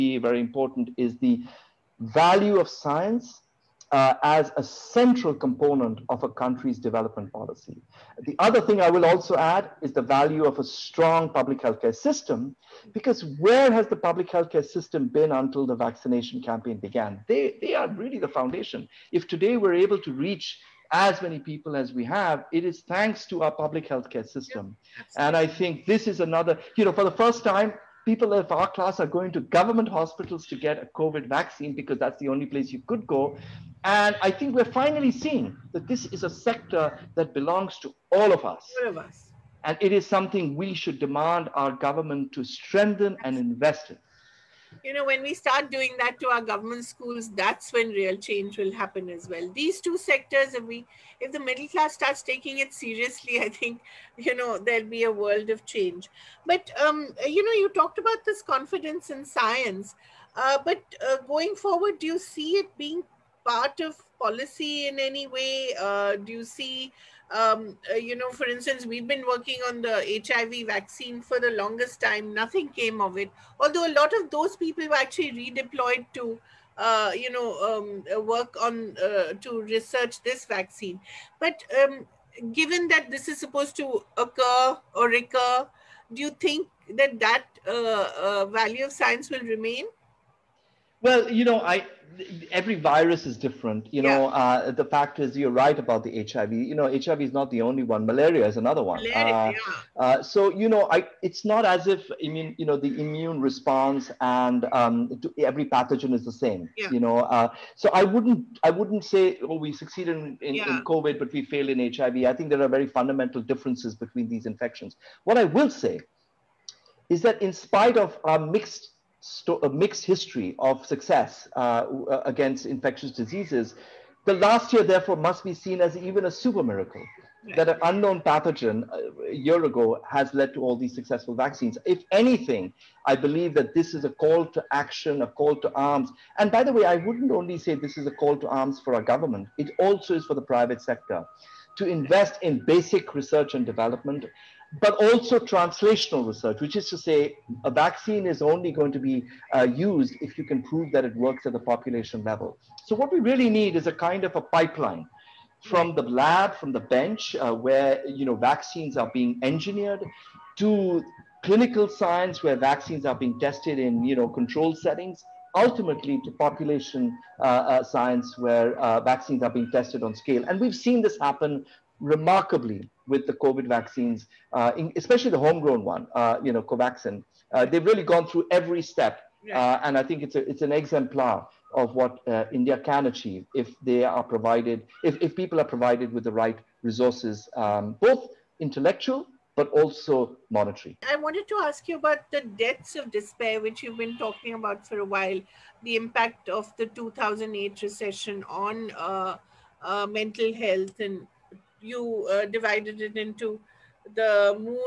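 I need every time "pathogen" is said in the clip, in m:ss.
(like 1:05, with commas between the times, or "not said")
1:45, 2:08.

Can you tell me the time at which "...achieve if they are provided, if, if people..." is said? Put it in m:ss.
3:03.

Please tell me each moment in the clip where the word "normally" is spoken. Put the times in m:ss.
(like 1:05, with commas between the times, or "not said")
not said.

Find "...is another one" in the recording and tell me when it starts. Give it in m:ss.
1:38.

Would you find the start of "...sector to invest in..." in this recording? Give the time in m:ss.
2:20.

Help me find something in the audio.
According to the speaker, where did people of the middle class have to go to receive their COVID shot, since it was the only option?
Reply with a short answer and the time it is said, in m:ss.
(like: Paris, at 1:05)
government hospitals, at 0:29.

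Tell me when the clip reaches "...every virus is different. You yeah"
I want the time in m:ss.
1:32.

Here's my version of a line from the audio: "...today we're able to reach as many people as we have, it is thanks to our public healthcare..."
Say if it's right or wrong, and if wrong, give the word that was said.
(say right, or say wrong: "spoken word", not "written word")
right.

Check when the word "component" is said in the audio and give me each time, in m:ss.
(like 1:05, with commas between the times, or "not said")
0:05.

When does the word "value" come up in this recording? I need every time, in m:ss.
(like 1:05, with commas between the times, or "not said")
0:01, 0:10, 1:28.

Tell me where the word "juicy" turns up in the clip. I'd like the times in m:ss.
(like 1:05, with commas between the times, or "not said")
not said.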